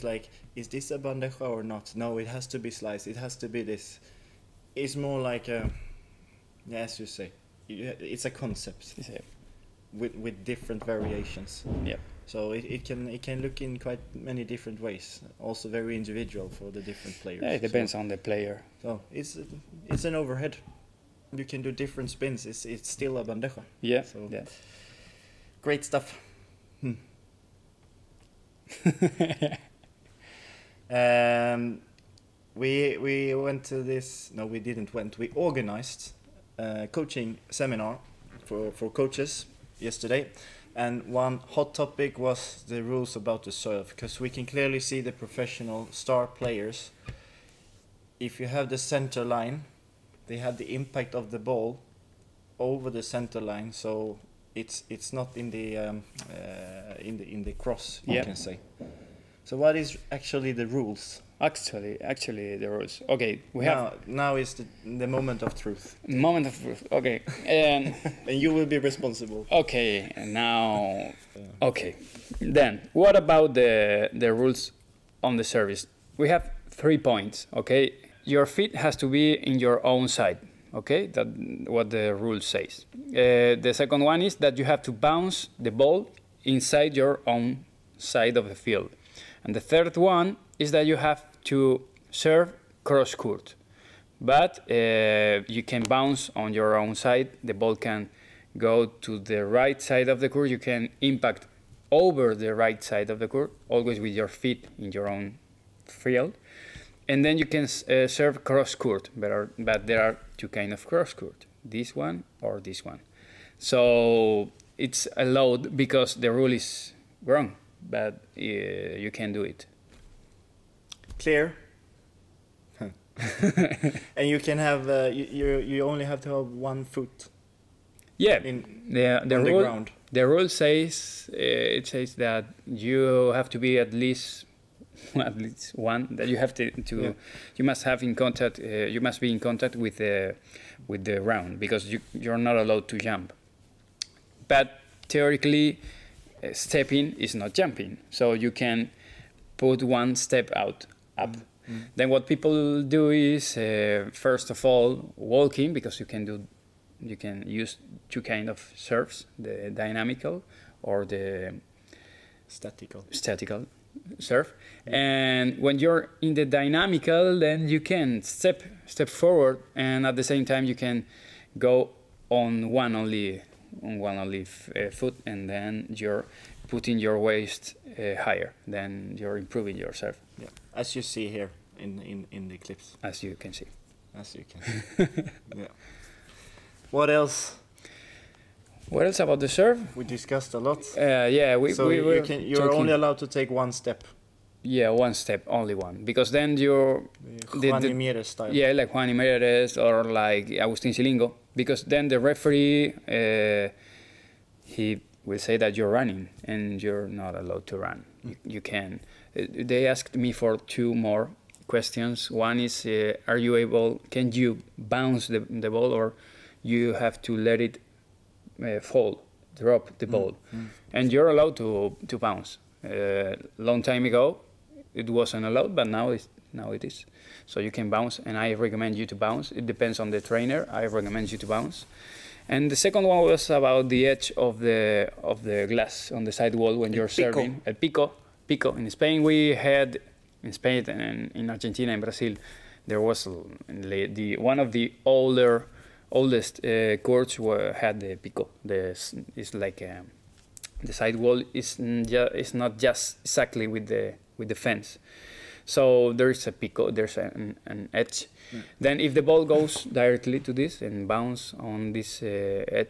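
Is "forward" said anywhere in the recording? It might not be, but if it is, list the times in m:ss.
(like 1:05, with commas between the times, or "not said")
2:49.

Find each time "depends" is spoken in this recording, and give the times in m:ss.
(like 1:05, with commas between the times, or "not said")
0:17, 3:49.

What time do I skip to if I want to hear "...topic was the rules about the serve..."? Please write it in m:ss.
0:41.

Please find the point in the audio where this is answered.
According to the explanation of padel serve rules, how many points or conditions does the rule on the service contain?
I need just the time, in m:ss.
1:16.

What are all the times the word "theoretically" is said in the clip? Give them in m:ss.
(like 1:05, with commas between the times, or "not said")
2:25.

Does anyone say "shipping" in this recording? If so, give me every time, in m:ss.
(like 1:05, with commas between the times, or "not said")
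not said.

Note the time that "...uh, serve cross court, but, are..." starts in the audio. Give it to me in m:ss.
1:47.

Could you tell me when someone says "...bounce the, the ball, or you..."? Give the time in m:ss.
3:34.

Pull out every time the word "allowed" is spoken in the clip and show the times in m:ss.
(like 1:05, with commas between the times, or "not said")
1:55, 2:22, 3:12, 3:27, 3:41, 3:45.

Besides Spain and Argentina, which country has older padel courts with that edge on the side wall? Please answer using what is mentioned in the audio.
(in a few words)
Brazil.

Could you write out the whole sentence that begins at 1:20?
Okay, that what the rule says.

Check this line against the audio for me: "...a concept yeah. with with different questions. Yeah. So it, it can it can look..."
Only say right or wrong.
wrong.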